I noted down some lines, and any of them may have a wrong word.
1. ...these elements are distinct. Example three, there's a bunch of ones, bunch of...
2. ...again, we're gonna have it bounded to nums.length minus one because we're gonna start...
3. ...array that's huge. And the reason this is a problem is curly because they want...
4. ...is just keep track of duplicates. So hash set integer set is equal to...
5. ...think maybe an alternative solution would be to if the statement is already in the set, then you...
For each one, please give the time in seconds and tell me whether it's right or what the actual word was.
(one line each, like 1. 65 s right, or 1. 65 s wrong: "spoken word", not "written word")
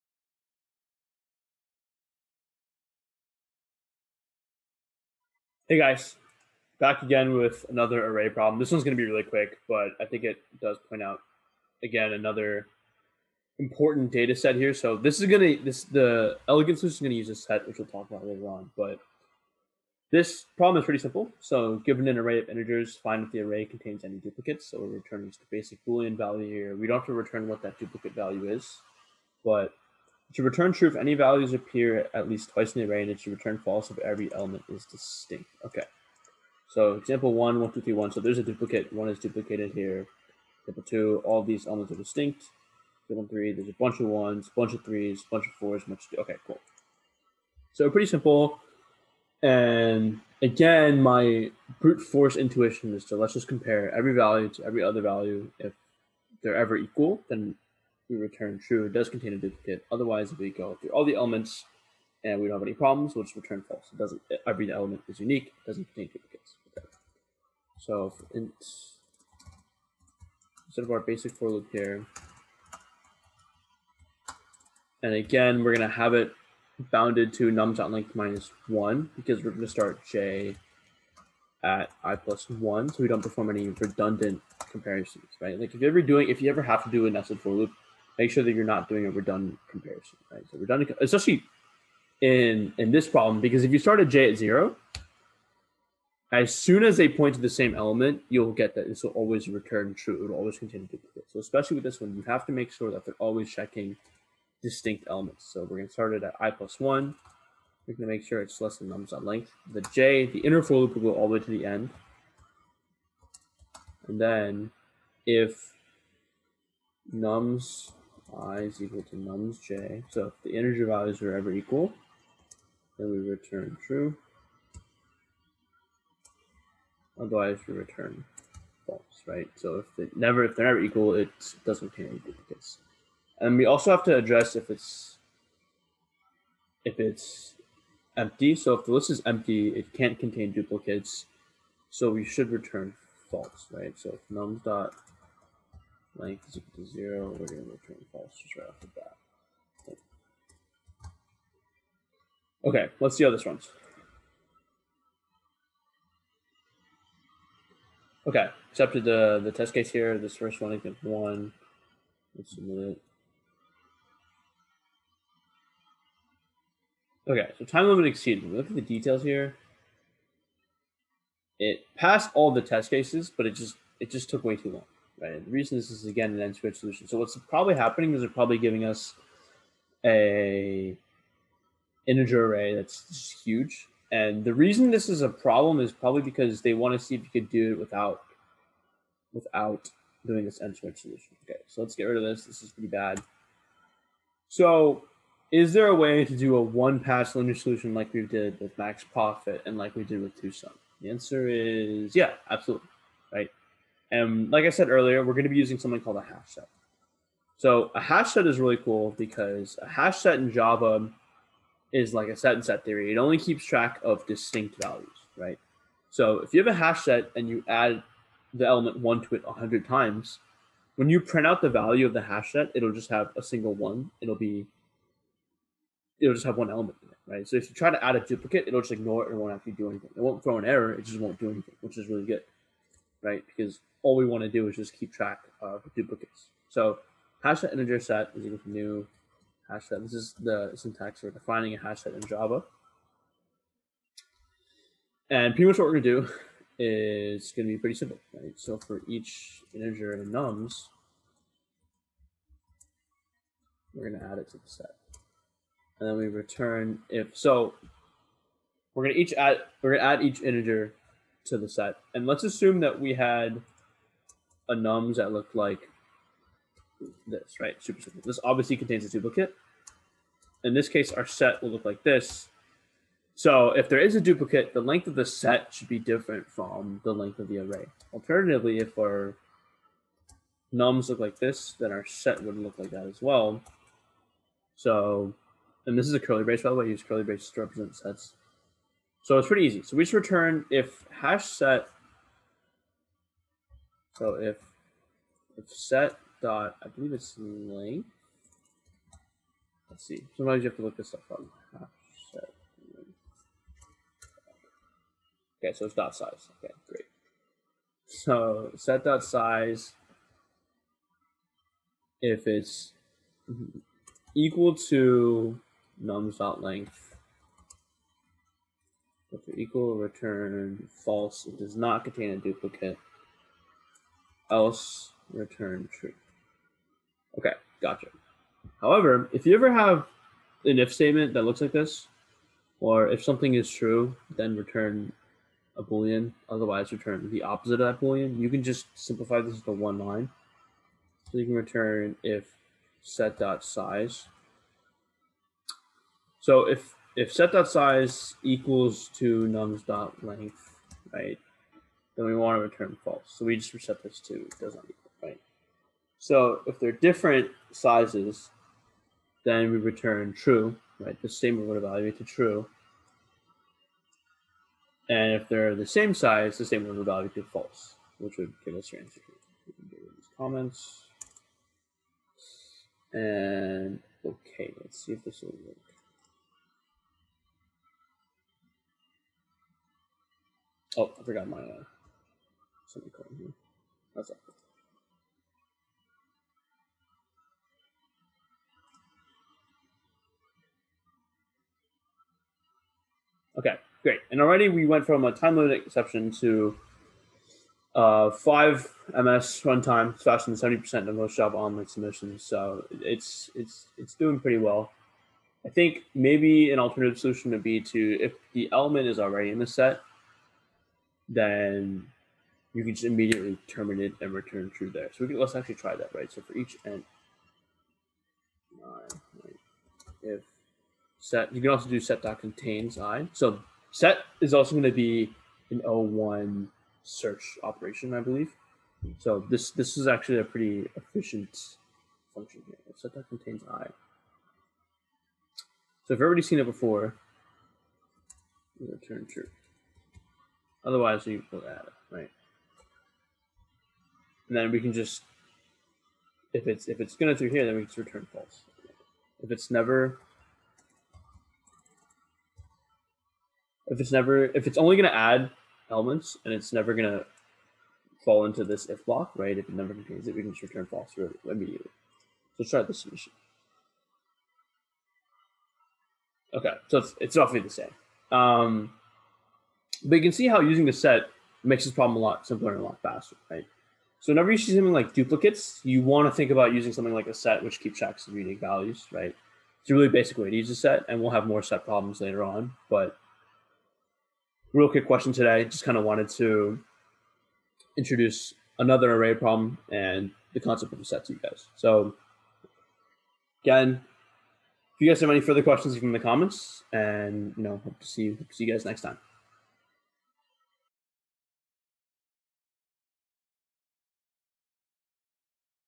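1. 41 s right
2. 75 s right
3. 182 s wrong: "probably", not "curly"
4. 234 s right
5. 405 s wrong: "element", not "statement".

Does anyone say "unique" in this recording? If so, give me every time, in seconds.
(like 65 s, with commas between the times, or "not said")
65 s, 478 s.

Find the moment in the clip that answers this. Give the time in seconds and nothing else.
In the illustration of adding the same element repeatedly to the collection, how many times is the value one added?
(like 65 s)
219 s.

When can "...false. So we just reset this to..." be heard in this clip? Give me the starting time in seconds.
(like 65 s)
353 s.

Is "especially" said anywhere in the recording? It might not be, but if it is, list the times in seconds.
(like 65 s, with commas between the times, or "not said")
91 s, 101 s.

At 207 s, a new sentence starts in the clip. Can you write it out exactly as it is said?
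So a hash set is really cool because a hash set in Java is like a set and set theory.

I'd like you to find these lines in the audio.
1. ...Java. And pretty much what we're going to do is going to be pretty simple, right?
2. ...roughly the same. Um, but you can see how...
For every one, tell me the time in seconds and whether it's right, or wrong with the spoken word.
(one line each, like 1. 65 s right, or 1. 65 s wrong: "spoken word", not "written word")
1. 242 s right
2. 467 s right.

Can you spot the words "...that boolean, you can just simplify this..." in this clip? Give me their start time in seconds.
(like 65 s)
337 s.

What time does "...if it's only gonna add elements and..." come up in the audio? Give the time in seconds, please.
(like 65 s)
454 s.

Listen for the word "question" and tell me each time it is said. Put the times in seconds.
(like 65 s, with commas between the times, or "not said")
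485 s, 495 s.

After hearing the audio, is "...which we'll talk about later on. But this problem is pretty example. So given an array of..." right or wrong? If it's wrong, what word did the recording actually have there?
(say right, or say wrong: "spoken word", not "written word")
wrong: "simple", not "example".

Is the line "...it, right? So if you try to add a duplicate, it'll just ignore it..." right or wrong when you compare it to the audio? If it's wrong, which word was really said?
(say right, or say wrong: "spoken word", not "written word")
right.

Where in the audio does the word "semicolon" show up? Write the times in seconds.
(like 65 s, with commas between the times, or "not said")
382 s.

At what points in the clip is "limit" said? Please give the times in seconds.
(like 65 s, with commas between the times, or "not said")
167 s, 395 s.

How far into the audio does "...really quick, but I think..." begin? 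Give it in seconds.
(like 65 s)
9 s.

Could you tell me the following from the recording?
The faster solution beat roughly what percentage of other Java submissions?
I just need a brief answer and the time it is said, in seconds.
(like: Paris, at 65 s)
70%, at 400 s.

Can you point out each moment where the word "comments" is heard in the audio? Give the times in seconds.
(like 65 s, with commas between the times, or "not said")
370 s, 496 s.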